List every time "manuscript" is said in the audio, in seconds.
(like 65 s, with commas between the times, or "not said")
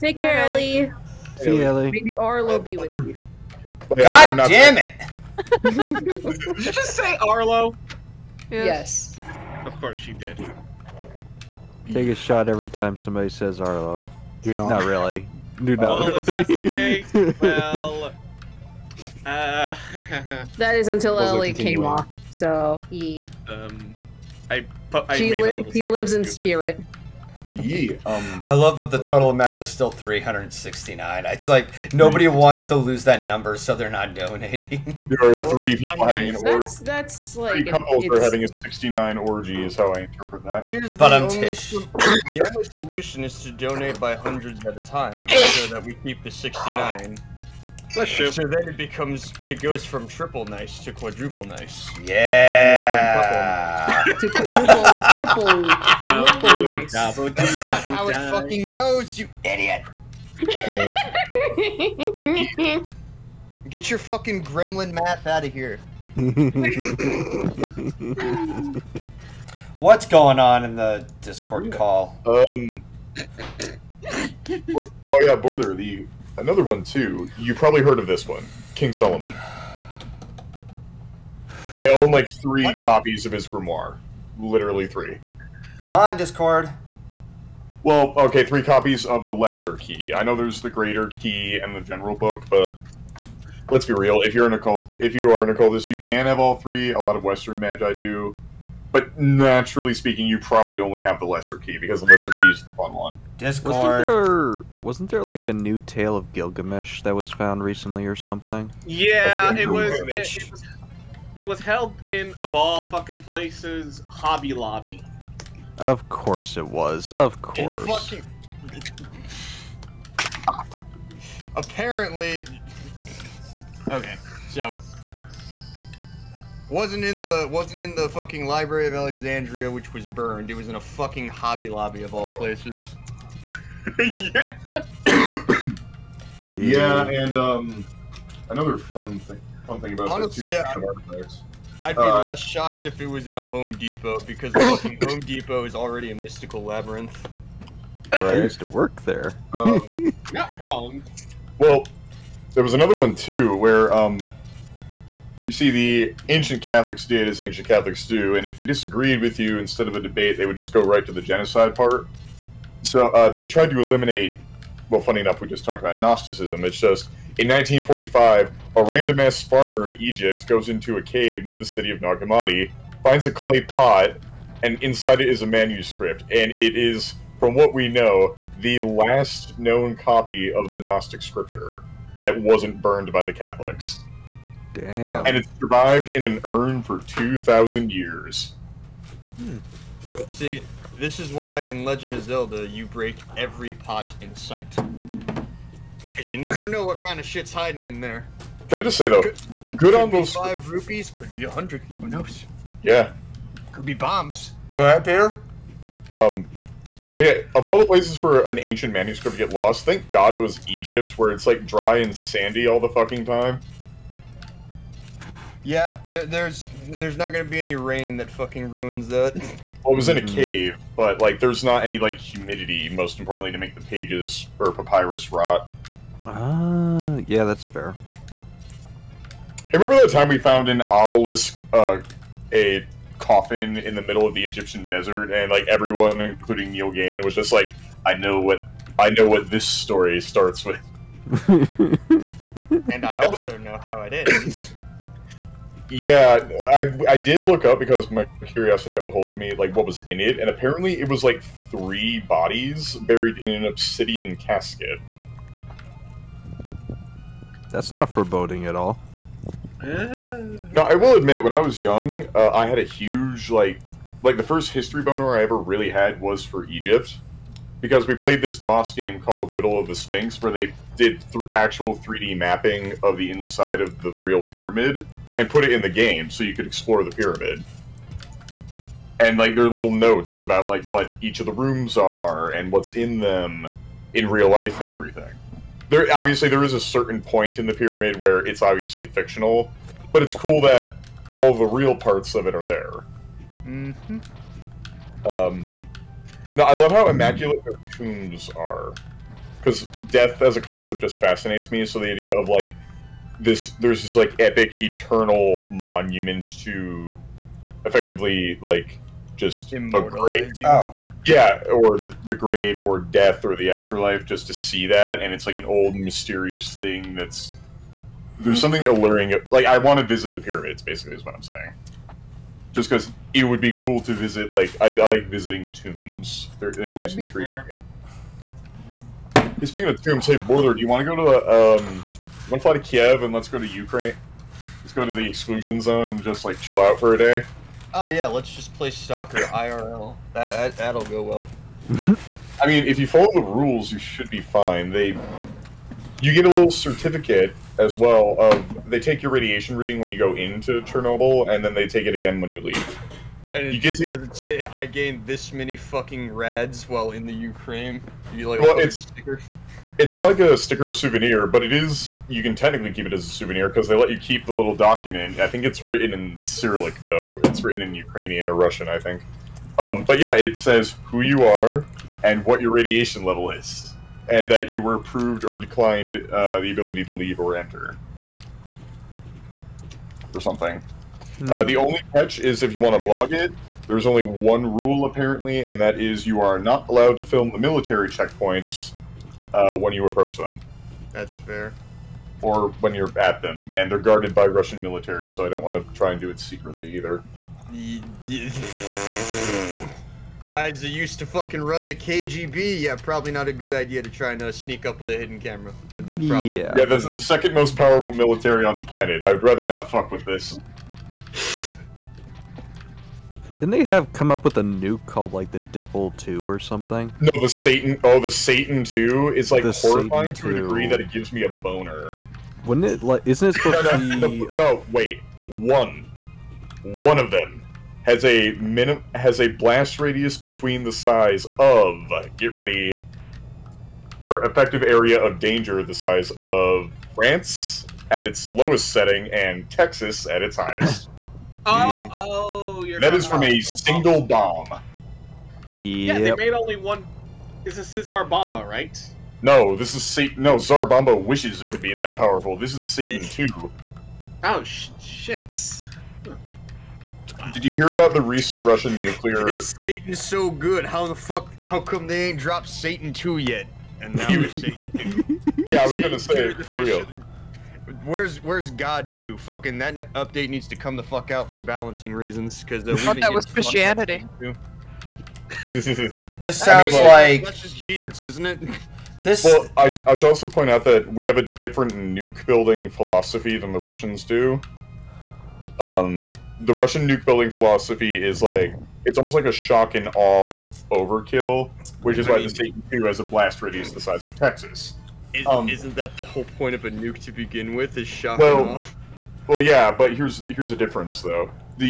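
175 s, 208 s.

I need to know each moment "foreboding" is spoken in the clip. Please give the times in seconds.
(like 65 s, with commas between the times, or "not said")
258 s.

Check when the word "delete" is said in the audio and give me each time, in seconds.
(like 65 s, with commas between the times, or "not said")
not said.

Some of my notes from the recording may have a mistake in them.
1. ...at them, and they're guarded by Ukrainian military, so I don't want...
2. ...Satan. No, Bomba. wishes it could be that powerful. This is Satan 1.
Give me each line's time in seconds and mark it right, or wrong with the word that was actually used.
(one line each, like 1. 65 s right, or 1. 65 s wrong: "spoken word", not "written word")
1. 393 s wrong: "Russian", not "Ukrainian"
2. 450 s wrong: "2", not "1".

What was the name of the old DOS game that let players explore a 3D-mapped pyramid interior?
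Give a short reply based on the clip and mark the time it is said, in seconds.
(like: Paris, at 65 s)
Riddle of the Sphinx, at 269 s.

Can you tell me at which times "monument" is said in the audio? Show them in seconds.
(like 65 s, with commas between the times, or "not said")
305 s.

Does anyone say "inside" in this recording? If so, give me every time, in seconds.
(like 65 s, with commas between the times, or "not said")
174 s, 273 s.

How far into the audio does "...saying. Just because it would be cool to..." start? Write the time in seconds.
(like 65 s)
321 s.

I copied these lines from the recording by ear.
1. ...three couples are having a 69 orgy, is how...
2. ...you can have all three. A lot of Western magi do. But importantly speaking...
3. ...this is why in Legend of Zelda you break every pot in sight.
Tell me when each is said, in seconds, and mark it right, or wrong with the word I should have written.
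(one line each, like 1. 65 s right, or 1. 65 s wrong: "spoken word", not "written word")
1. 37 s right
2. 95 s wrong: "naturally", not "importantly"
3. 190 s right.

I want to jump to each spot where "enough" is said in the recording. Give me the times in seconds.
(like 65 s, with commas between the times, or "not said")
165 s.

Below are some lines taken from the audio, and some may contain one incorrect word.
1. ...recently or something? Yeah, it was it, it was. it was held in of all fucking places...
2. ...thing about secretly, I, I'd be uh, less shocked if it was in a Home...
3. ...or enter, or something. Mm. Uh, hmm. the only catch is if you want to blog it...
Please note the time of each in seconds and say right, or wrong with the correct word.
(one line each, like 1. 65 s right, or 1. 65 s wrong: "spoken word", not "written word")
1. 107 s right
2. 139 s wrong: "honestly", not "secretly"
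3. 377 s right.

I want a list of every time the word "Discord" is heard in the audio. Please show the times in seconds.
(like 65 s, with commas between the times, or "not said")
71 s, 86 s, 103 s.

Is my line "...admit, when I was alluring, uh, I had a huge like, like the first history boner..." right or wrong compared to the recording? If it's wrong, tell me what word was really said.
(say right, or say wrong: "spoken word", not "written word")
wrong: "young", not "alluring".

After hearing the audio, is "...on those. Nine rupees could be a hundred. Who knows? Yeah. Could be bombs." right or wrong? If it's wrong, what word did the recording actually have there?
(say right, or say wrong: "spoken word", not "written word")
wrong: "Five", not "Nine".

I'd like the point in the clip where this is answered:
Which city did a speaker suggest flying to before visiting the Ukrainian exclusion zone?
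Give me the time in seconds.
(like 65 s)
332 s.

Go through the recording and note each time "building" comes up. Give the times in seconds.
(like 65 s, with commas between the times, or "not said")
482 s, 487 s.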